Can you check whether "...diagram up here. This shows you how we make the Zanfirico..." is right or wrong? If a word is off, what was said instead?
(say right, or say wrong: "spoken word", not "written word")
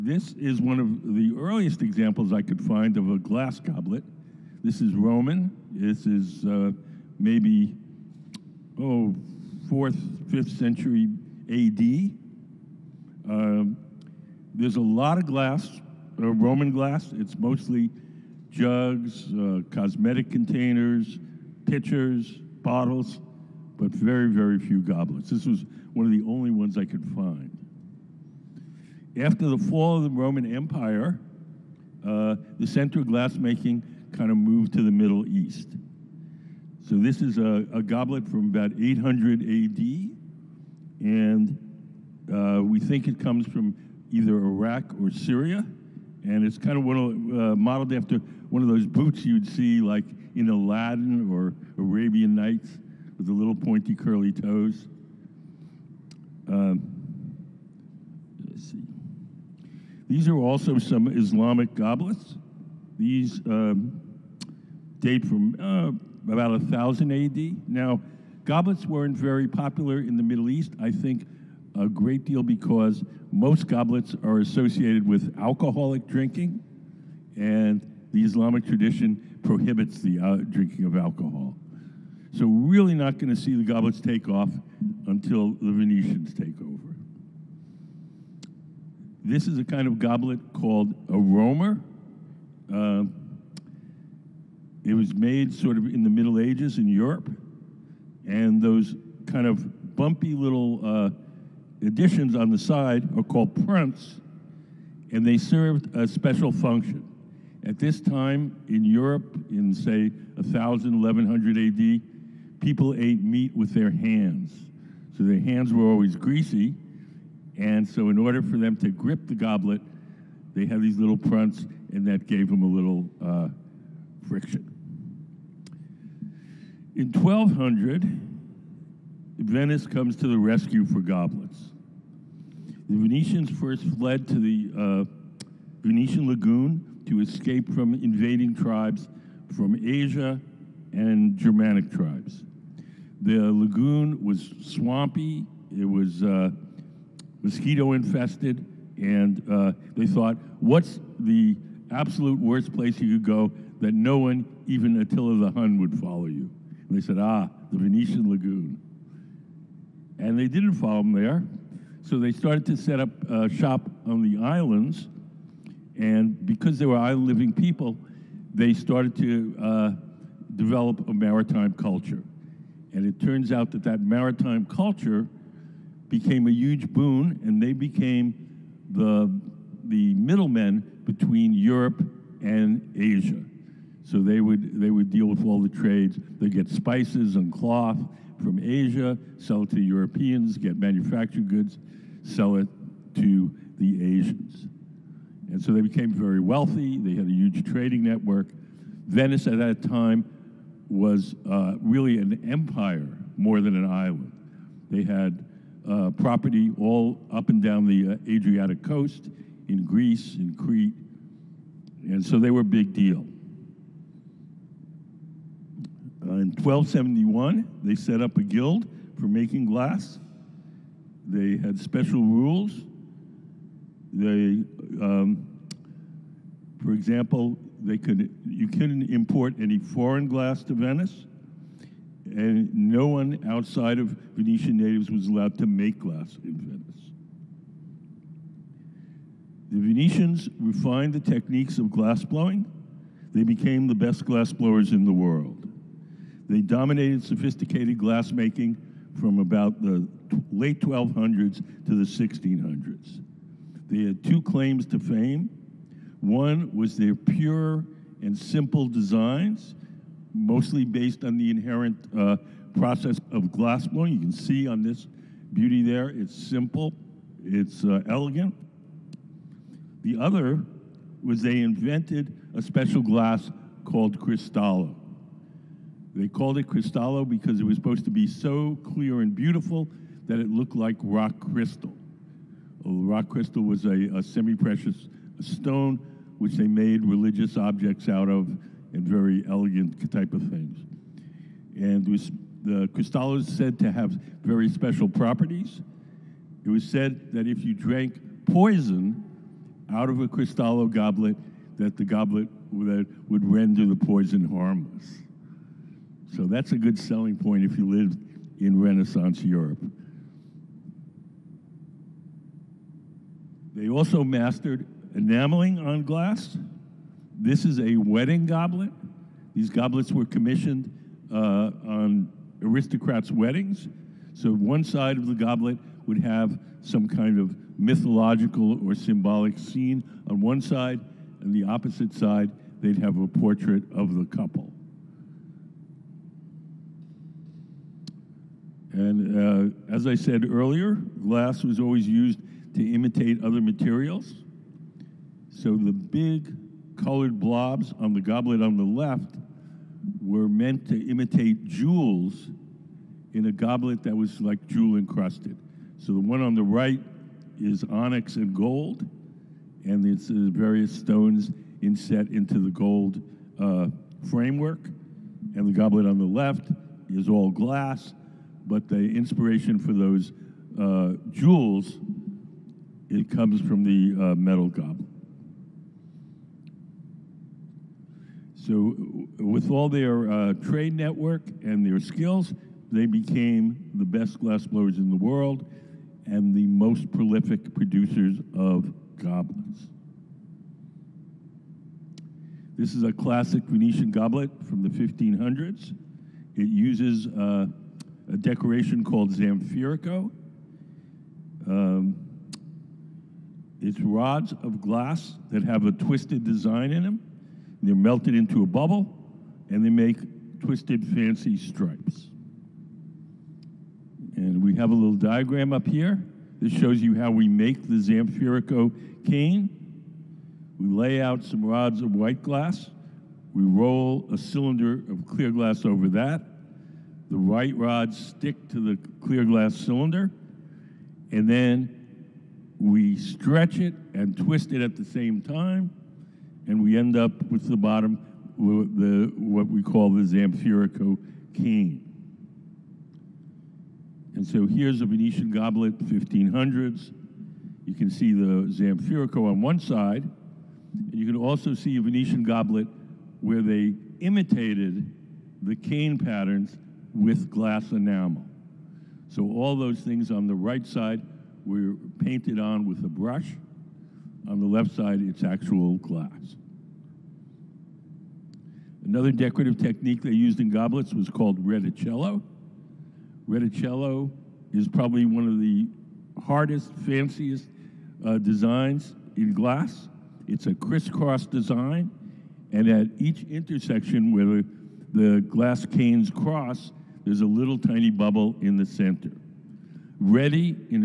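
right.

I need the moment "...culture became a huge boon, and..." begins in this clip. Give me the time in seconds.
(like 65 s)
174 s.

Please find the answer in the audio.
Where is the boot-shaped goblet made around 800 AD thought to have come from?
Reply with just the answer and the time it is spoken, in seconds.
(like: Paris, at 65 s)
Iraq or Syria, at 44 s.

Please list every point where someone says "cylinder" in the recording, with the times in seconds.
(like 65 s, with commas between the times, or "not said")
424 s, 429 s.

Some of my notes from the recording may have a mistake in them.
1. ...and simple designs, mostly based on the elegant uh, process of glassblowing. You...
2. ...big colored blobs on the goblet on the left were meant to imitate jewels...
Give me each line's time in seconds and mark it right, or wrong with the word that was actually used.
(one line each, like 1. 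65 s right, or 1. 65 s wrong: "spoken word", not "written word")
1. 258 s wrong: "inherent", not "elegant"
2. 345 s right.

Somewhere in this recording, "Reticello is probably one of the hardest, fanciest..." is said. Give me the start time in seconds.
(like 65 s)
473 s.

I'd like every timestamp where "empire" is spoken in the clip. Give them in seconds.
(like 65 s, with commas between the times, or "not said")
30 s, 202 s.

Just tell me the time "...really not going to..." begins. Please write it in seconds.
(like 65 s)
82 s.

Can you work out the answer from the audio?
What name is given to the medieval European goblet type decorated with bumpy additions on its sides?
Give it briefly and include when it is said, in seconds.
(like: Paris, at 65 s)
Roamer, at 91 s.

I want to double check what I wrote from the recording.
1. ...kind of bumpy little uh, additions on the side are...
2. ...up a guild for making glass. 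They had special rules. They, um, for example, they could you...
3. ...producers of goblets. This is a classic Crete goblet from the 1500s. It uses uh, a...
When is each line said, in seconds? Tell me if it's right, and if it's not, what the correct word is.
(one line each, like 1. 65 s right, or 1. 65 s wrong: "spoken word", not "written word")
1. 99 s right
2. 218 s right
3. 387 s wrong: "Venetian", not "Crete".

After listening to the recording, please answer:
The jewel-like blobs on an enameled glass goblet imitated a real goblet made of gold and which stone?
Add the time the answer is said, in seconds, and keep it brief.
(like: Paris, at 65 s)
Onyx, at 357 s.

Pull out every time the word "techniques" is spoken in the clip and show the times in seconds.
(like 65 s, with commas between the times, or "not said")
241 s, 469 s.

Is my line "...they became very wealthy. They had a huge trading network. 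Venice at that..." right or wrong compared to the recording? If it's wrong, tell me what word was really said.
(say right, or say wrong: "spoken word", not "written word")
right.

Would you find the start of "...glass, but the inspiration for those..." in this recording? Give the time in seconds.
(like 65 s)
367 s.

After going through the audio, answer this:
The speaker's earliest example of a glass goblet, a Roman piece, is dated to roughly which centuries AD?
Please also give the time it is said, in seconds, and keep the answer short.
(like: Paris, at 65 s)
4th-5th century, at 9 s.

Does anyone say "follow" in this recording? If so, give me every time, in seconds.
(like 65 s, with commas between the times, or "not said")
155 s, 160 s.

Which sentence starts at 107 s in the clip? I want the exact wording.
At this time in Europe, in say 1000, 1100 AD, people ate meat with their hands.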